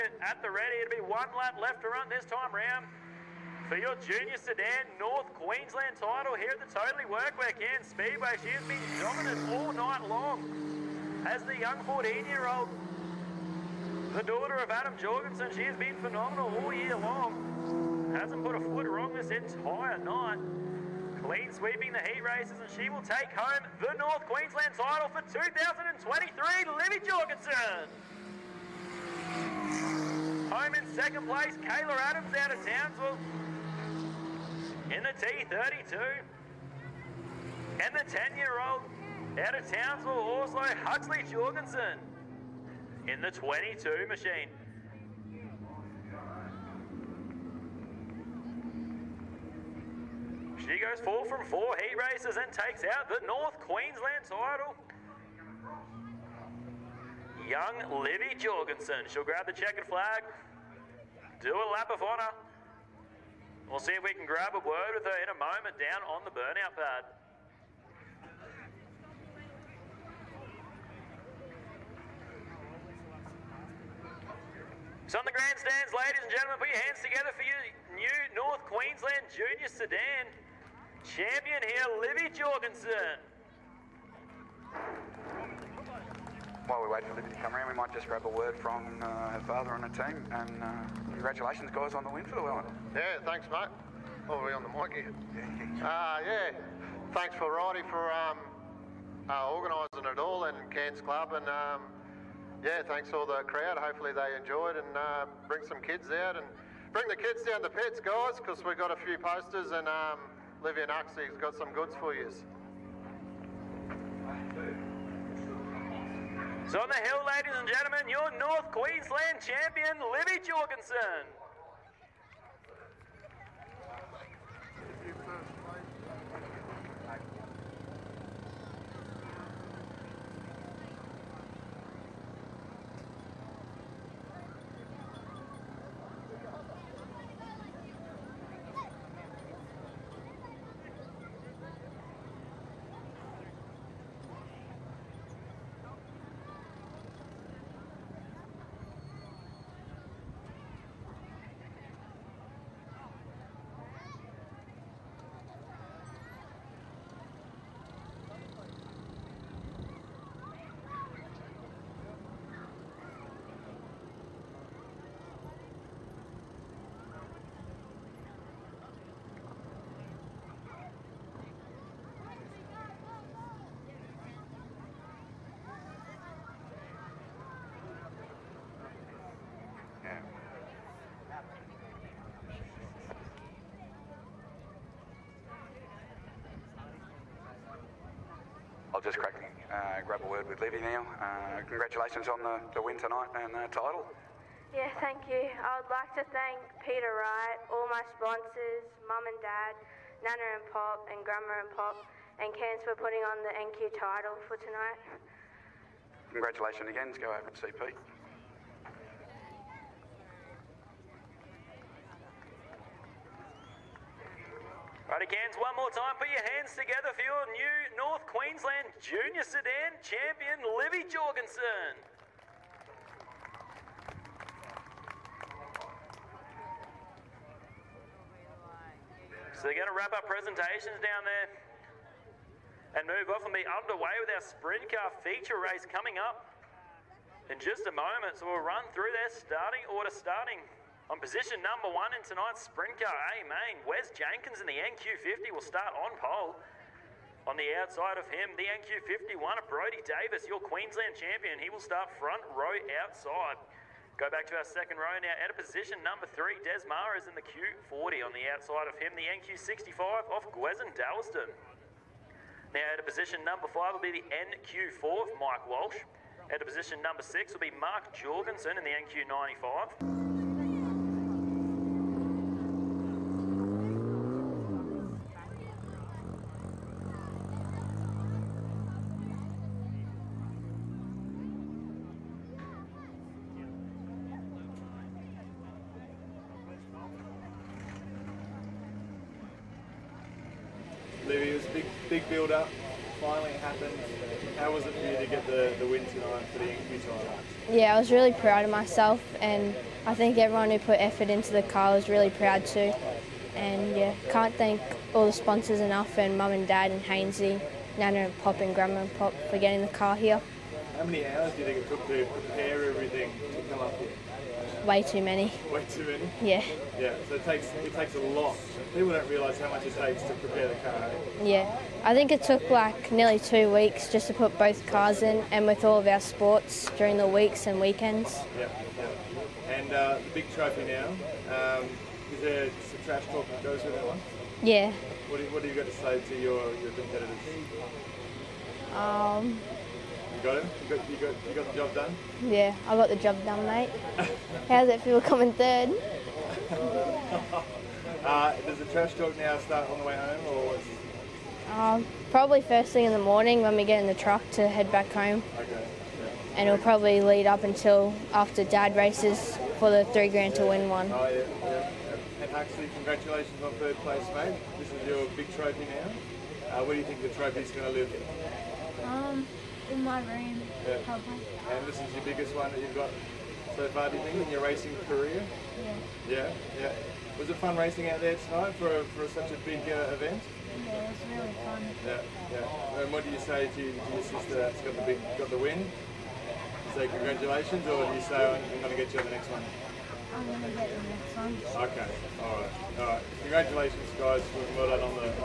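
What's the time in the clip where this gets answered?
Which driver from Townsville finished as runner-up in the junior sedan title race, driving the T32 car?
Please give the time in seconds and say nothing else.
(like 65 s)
31 s.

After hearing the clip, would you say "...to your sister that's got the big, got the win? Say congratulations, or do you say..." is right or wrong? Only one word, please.
right.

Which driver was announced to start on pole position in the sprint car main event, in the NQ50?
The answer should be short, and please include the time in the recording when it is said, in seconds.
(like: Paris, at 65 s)
Wes Jenkins, at 243 s.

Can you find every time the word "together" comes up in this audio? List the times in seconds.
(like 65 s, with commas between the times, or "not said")
77 s, 216 s.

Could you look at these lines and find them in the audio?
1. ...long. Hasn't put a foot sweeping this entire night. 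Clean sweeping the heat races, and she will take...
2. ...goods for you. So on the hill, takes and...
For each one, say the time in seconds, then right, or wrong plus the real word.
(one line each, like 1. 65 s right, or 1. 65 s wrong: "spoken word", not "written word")
1. 16 s wrong: "wrong", not "sweeping"
2. 111 s wrong: "ladies", not "takes".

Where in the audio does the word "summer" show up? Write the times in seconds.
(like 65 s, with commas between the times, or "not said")
not said.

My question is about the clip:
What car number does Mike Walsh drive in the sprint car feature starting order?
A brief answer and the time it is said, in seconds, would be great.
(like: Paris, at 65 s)
NQ4, at 264 s.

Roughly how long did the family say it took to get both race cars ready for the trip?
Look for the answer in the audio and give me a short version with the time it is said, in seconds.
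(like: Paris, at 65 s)
nearly two weeks, at 323 s.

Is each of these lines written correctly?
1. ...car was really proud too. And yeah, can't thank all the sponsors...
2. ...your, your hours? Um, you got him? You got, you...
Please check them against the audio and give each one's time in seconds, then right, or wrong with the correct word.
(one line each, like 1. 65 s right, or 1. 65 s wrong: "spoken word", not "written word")
1. 301 s right
2. 336 s wrong: "competitors", not "hours".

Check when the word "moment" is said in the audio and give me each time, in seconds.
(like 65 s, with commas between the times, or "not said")
65 s, 237 s.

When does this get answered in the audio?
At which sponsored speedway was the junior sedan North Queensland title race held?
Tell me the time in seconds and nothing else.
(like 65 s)
6 s.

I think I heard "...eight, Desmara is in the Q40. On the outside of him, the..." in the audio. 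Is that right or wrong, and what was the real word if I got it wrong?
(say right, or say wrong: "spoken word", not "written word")
wrong: "three", not "eight".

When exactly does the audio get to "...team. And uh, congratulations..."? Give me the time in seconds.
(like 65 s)
89 s.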